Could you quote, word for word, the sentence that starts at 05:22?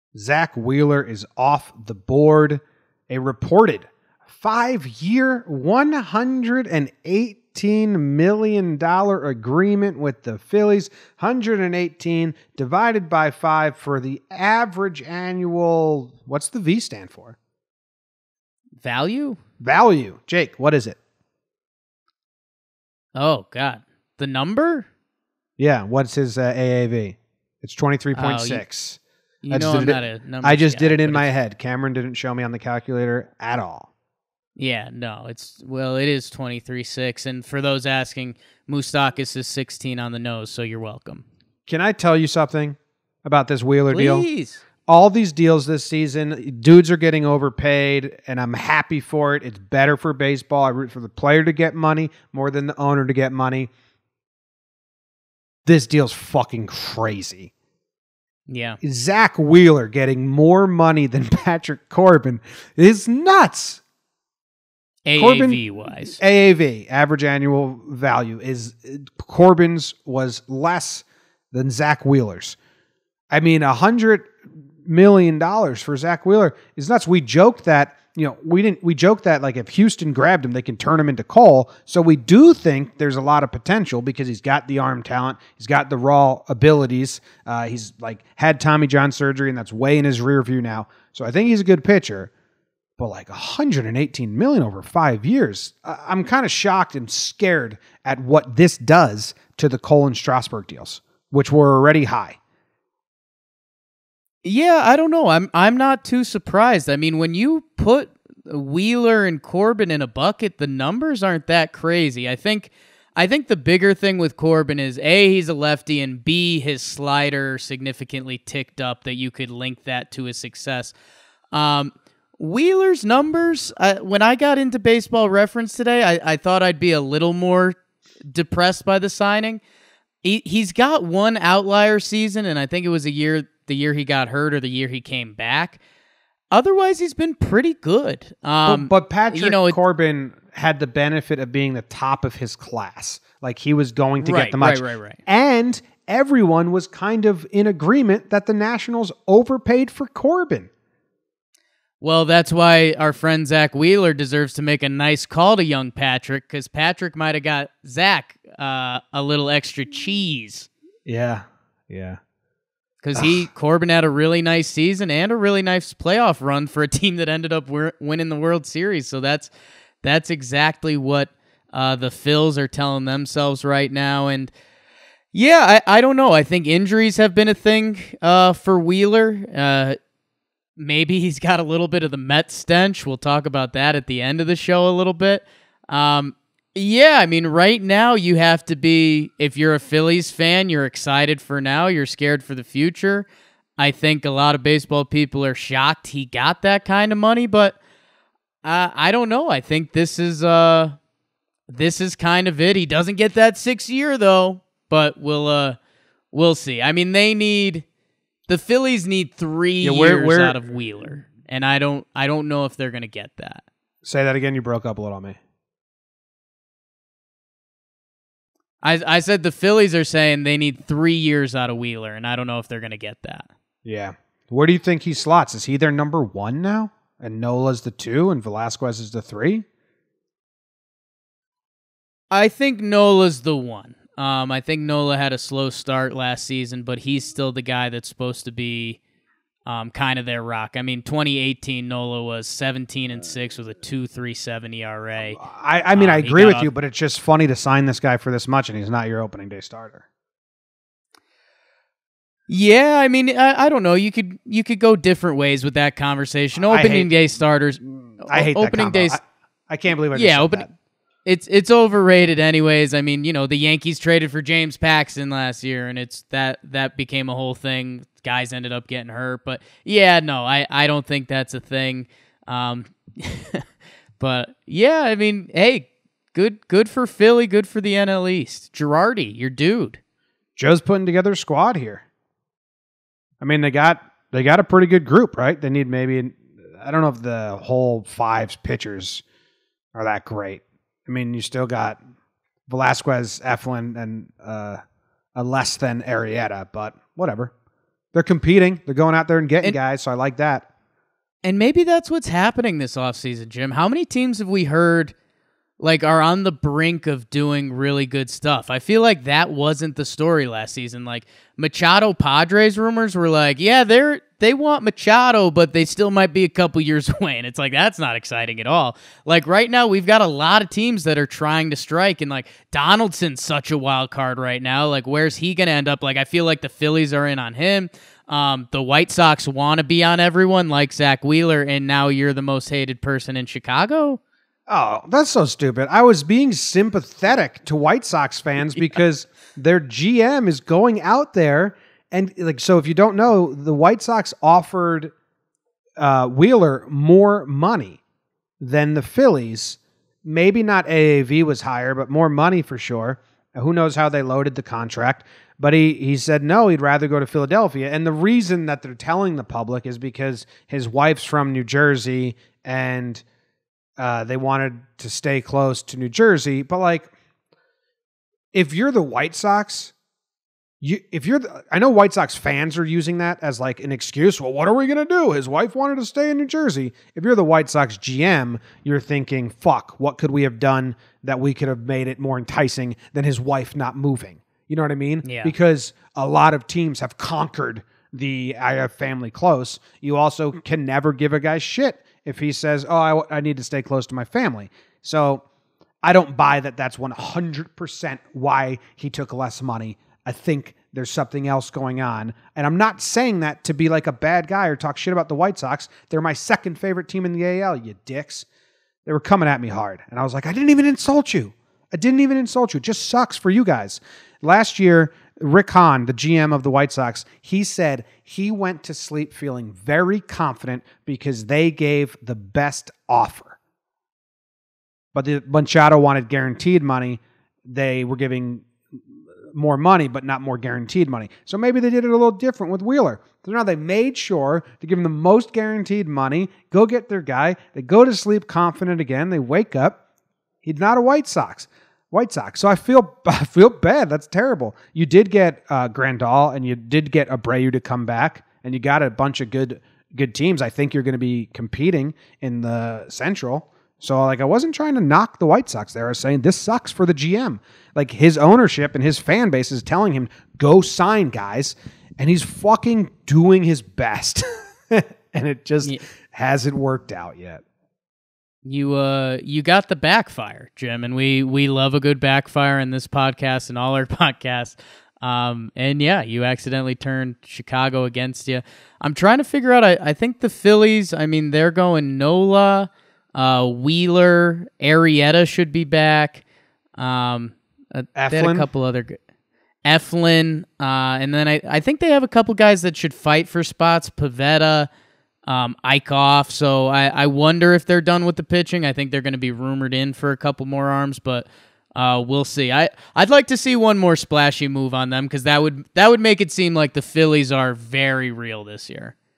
And like Donaldson's such a wild card right now.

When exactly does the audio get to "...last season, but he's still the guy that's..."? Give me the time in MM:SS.
03:56.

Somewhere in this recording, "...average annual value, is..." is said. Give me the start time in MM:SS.
01:06.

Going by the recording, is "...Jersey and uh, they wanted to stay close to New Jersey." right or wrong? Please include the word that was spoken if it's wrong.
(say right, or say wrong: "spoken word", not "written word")
right.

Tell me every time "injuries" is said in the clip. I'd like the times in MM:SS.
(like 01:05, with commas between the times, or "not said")
02:56.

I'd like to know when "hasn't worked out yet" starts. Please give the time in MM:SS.
07:46.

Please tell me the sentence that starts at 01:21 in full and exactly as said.
So we do think there's a lot of potential because he's got the arm talent, he's got the raw abilities.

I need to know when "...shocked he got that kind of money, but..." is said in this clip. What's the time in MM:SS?
03:15.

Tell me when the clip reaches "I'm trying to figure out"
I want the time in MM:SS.
07:58.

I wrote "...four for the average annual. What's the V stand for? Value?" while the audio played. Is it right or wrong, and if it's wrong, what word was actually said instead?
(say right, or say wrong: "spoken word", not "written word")
wrong: "five", not "four".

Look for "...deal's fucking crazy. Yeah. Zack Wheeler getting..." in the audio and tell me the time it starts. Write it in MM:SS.
00:55.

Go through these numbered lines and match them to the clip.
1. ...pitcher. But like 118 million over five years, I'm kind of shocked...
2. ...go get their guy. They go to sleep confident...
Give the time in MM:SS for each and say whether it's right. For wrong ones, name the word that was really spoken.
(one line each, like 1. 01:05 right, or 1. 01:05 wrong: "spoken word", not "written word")
1. 01:31 right
2. 07:16 right.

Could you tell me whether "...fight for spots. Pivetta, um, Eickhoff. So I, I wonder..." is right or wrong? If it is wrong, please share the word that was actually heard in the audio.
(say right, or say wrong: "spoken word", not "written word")
right.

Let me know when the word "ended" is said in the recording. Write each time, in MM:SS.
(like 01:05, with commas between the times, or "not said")
02:47, 04:28.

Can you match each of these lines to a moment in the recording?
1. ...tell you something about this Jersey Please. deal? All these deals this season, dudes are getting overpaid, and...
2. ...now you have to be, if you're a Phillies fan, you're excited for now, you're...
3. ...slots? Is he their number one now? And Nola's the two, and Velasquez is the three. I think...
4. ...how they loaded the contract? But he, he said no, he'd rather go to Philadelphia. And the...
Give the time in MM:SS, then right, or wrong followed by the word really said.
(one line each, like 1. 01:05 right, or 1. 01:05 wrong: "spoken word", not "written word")
1. 00:41 wrong: "Wheeler", not "Jersey"
2. 03:07 right
3. 03:45 right
4. 05:53 right.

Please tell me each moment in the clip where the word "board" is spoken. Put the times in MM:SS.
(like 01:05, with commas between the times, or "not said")
00:01.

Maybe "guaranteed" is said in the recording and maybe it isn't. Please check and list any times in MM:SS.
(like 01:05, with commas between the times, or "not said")
07:06, 07:10, 07:15.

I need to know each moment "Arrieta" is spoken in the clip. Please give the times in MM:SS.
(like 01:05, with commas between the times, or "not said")
04:56, 08:04.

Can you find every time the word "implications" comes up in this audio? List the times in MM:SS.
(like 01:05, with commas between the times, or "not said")
not said.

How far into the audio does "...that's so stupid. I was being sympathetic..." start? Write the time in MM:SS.
05:35.